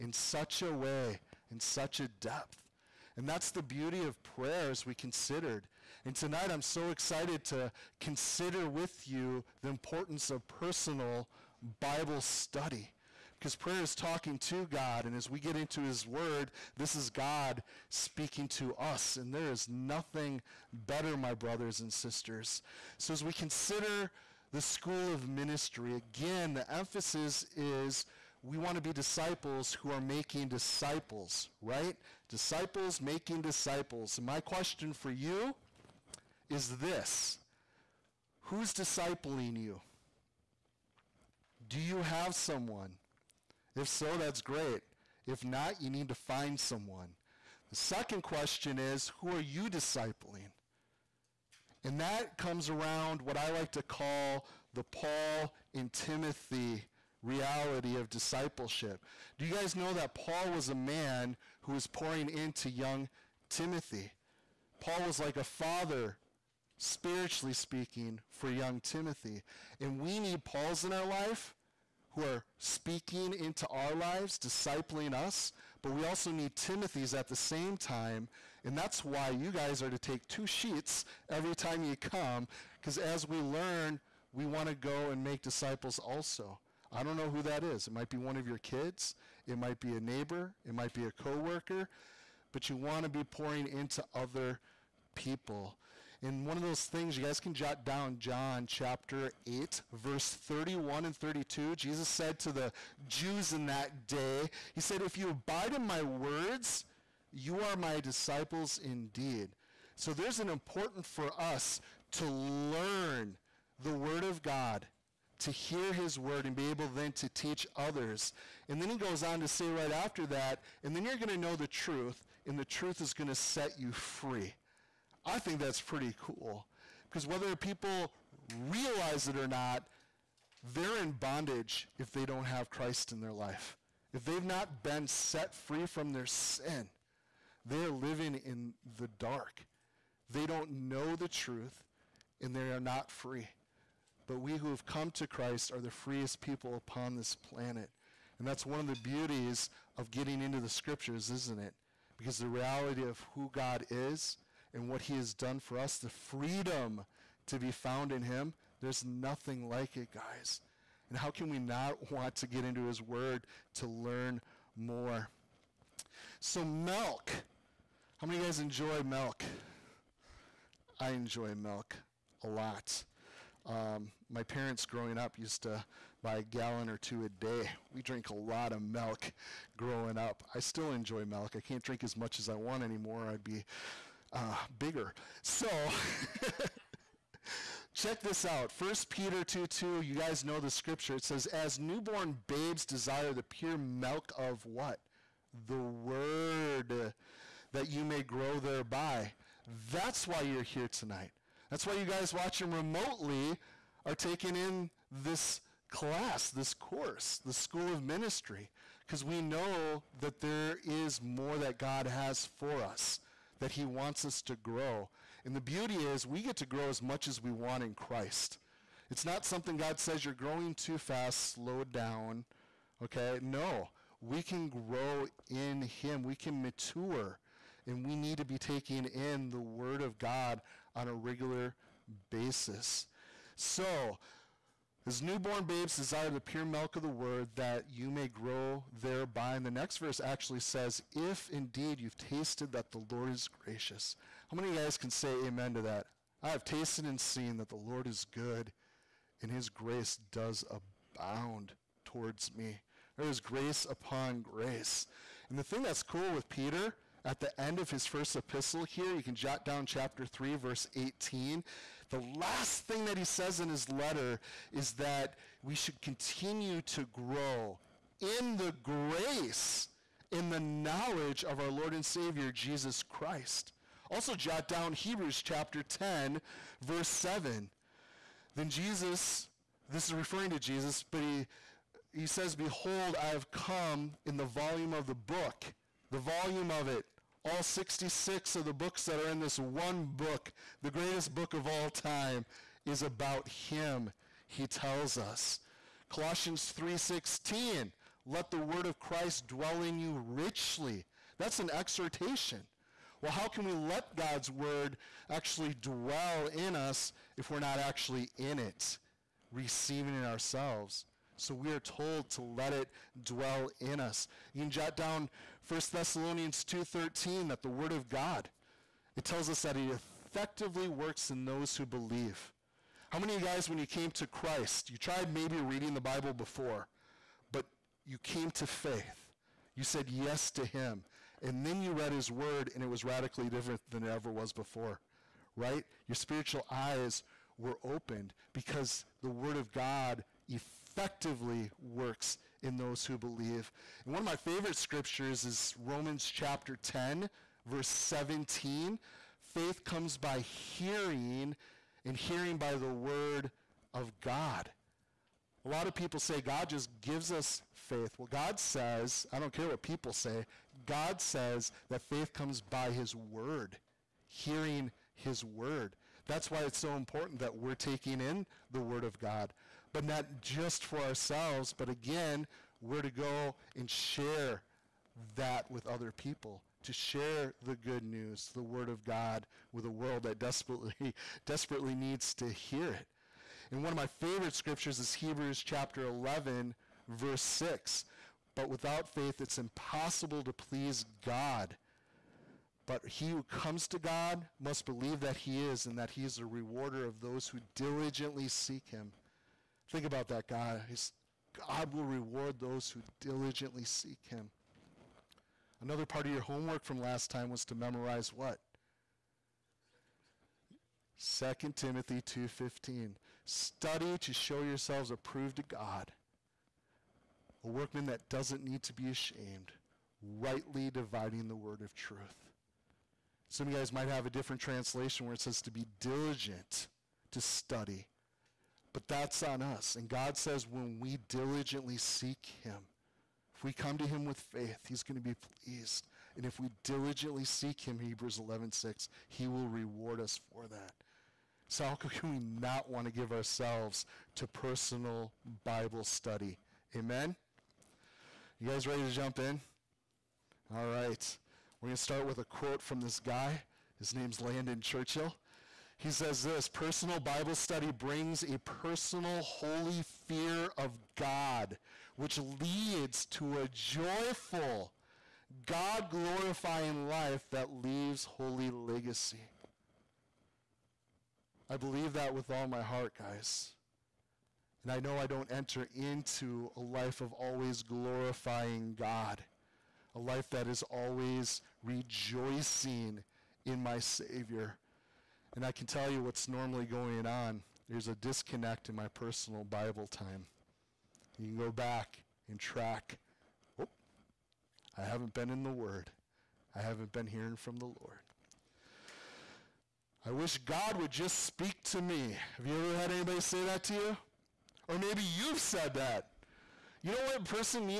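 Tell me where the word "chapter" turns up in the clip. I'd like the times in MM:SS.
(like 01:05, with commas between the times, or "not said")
01:38, 04:19, 04:35, 05:46, 06:25.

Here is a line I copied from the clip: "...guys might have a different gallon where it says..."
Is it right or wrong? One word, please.
wrong.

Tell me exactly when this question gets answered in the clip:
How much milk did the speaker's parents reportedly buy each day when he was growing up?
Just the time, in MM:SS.
02:56.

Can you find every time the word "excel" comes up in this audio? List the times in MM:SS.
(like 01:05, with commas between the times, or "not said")
not said.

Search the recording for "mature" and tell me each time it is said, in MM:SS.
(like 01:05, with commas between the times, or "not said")
03:46.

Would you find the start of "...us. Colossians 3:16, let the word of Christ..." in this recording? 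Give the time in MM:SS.
04:55.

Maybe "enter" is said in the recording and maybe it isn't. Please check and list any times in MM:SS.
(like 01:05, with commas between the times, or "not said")
07:55.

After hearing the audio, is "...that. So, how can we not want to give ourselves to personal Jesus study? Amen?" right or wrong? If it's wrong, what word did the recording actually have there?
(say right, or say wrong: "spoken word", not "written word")
wrong: "Bible", not "Jesus".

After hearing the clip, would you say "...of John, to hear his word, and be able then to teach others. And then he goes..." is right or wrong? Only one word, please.
wrong.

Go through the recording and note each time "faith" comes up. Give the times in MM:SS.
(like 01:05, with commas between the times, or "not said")
05:28, 05:49, 05:57, 06:02, 06:29, 07:14.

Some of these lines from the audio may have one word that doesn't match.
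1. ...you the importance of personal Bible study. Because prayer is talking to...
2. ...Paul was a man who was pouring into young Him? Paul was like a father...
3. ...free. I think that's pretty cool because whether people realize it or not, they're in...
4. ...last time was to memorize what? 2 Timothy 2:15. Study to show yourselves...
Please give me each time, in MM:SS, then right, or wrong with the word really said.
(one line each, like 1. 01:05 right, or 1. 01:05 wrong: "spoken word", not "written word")
1. 00:09 right
2. 01:00 wrong: "Timothy", not "Him"
3. 02:03 right
4. 06:47 right.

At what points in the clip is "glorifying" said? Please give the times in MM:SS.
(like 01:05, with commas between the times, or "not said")
07:46, 07:57.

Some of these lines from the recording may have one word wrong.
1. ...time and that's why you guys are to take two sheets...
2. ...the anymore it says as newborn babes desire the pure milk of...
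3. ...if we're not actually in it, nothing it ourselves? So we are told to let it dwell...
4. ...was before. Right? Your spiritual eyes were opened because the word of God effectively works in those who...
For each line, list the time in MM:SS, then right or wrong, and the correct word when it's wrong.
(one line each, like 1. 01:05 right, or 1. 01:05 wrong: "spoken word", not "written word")
1. 01:17 right
2. 03:10 wrong: "scripture", not "anymore"
3. 05:07 wrong: "receiving", not "nothing"
4. 05:34 right.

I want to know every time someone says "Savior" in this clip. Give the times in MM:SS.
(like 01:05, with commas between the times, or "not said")
04:32, 08:03.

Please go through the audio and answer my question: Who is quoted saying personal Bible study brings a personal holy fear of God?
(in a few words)
Landon Churchill.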